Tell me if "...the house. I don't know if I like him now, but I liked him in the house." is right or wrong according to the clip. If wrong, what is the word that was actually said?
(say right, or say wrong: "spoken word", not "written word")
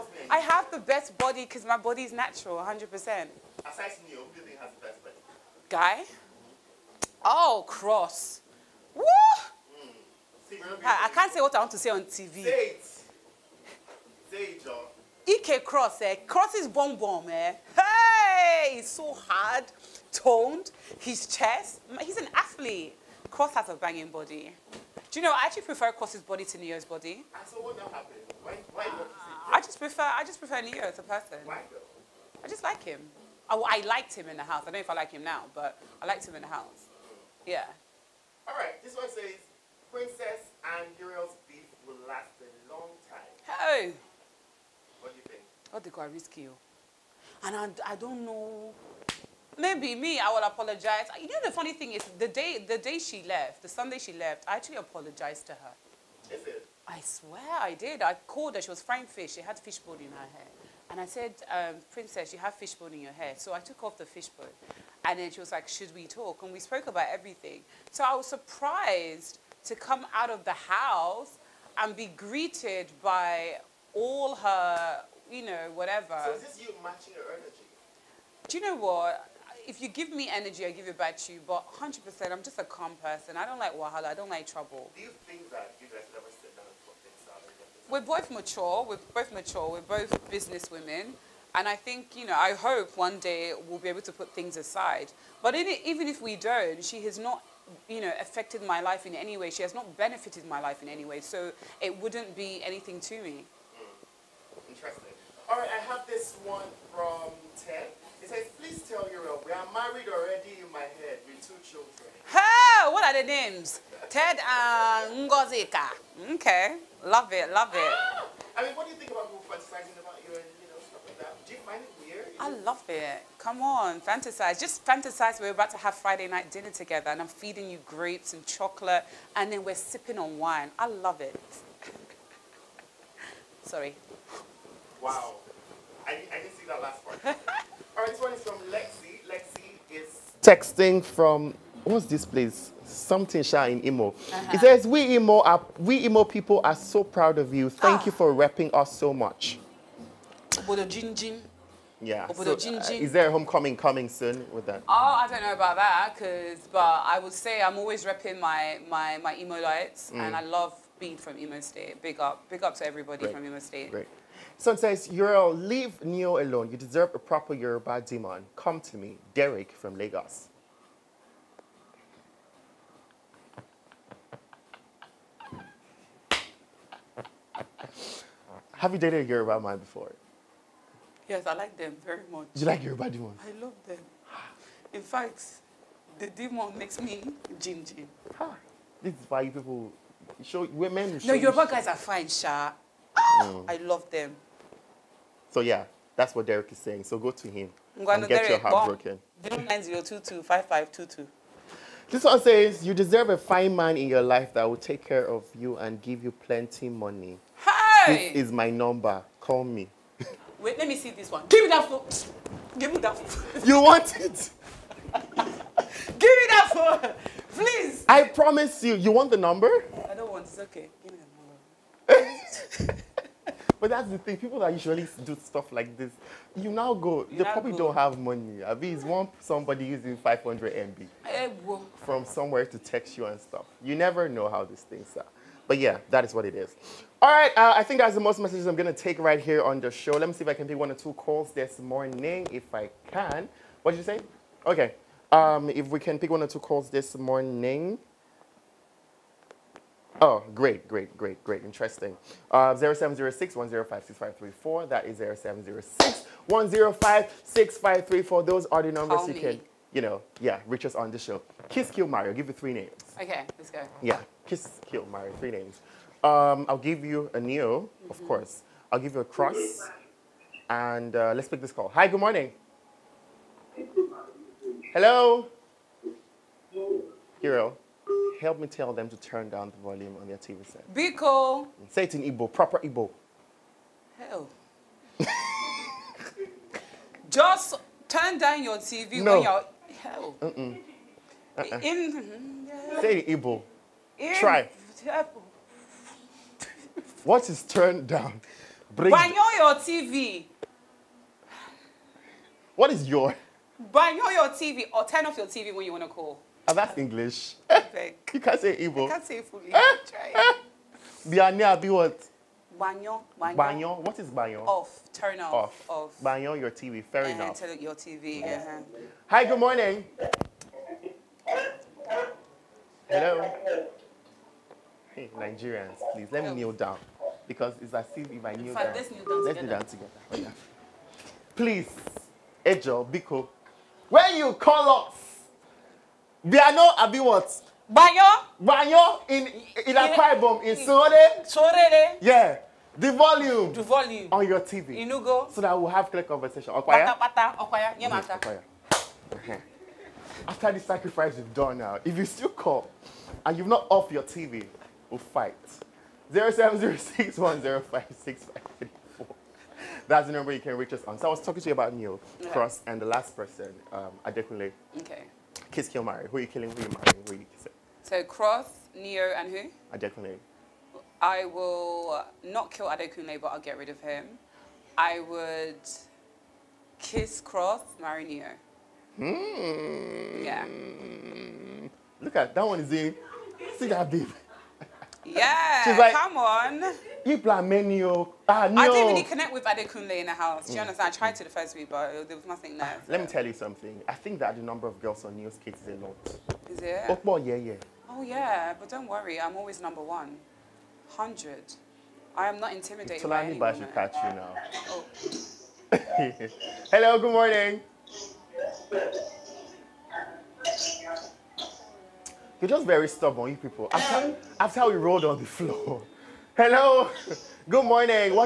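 right.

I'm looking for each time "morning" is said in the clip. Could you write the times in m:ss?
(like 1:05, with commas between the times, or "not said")
4:01, 4:07, 4:32, 5:19, 6:47, 6:57.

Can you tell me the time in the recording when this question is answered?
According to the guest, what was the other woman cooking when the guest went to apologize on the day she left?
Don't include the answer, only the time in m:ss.
0:58.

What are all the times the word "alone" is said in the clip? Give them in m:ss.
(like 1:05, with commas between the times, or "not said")
2:46.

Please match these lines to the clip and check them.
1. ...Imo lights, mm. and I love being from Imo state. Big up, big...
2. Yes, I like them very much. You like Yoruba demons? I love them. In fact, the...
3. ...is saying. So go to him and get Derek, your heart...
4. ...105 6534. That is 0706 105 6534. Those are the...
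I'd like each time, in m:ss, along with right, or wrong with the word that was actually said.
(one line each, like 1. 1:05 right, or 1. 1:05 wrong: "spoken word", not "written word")
1. 2:39 right
2. 3:01 right
3. 3:16 right
4. 4:13 right.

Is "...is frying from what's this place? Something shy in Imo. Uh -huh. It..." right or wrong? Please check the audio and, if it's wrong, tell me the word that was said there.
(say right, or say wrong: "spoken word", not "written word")
wrong: "texting", not "frying".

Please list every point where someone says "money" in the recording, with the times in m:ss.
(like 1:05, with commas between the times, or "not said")
3:26, 3:48.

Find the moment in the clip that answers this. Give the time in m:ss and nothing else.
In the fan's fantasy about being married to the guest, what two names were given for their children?
1:54.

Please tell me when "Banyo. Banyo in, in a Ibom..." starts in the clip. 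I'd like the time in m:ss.
5:37.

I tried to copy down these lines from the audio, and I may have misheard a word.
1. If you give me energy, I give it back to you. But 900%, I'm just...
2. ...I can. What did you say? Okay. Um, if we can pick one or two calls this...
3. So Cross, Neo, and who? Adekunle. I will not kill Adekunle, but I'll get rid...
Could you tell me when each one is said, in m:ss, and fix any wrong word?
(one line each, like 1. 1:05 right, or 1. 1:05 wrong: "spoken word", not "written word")
1. 1:19 wrong: "100", not "900"
2. 4:02 right
3. 6:08 right.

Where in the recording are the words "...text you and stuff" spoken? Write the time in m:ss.
3:52.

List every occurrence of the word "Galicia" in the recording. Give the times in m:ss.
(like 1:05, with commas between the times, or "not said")
not said.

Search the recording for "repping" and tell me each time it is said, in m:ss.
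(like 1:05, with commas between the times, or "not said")
2:28, 2:38.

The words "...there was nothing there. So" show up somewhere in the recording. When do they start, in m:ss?
6:32.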